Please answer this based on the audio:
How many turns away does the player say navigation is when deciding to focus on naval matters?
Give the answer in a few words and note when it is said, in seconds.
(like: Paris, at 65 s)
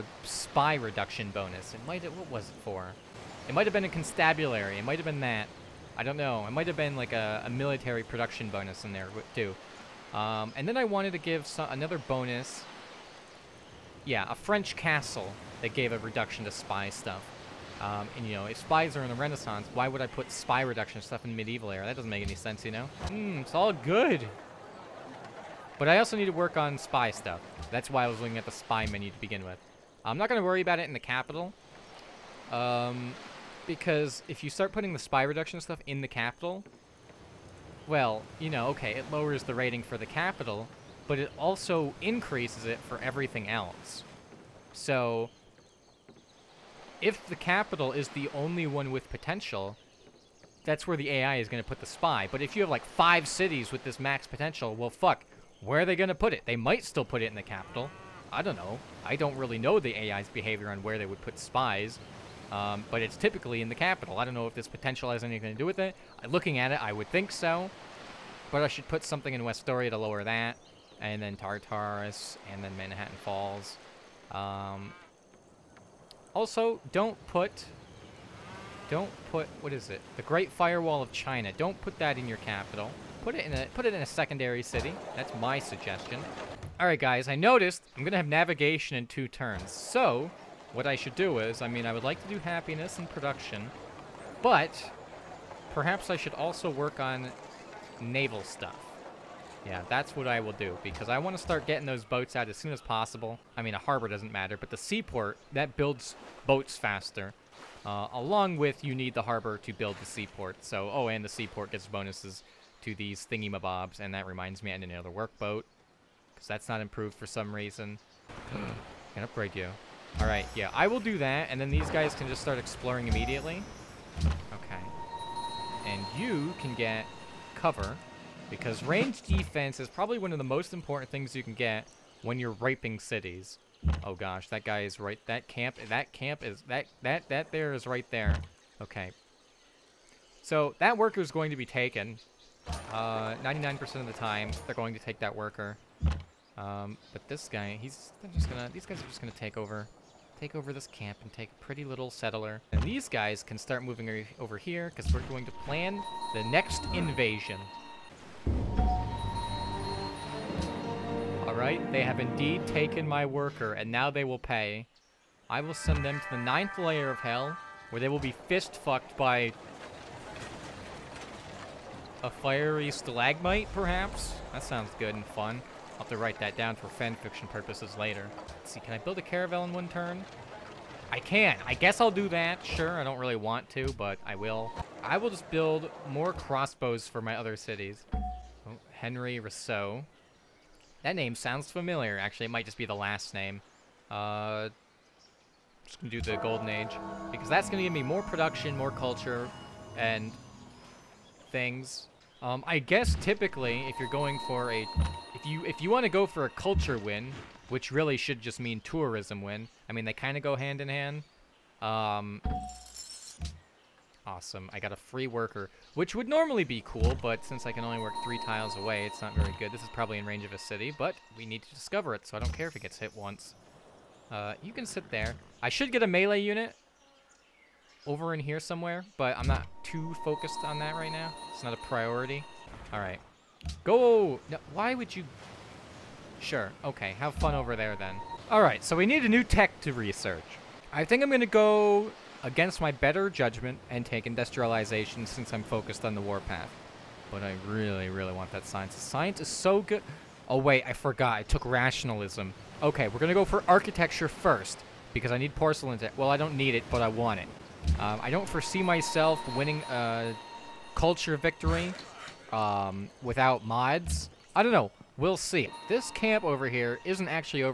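2, at 89 s.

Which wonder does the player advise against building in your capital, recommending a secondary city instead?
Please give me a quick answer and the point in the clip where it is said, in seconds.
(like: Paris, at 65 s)
Great Firewall of China, at 80 s.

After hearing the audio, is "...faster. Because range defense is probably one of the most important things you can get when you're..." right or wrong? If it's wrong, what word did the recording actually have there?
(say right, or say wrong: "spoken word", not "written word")
wrong: "cover", not "faster".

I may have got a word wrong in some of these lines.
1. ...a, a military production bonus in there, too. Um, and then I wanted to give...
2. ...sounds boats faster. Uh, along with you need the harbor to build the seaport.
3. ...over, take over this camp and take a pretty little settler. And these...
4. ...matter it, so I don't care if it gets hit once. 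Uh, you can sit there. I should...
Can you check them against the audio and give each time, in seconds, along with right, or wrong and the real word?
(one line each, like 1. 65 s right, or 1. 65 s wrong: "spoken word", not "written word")
1. 7 s right
2. 105 s wrong: "builds", not "sounds"
3. 149 s right
4. 221 s wrong: "discover", not "matter".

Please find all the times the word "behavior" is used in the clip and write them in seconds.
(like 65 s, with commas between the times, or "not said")
60 s.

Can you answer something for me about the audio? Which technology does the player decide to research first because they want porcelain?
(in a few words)
Architecture.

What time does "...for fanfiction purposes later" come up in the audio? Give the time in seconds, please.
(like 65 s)
176 s.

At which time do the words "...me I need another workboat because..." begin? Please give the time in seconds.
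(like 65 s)
114 s.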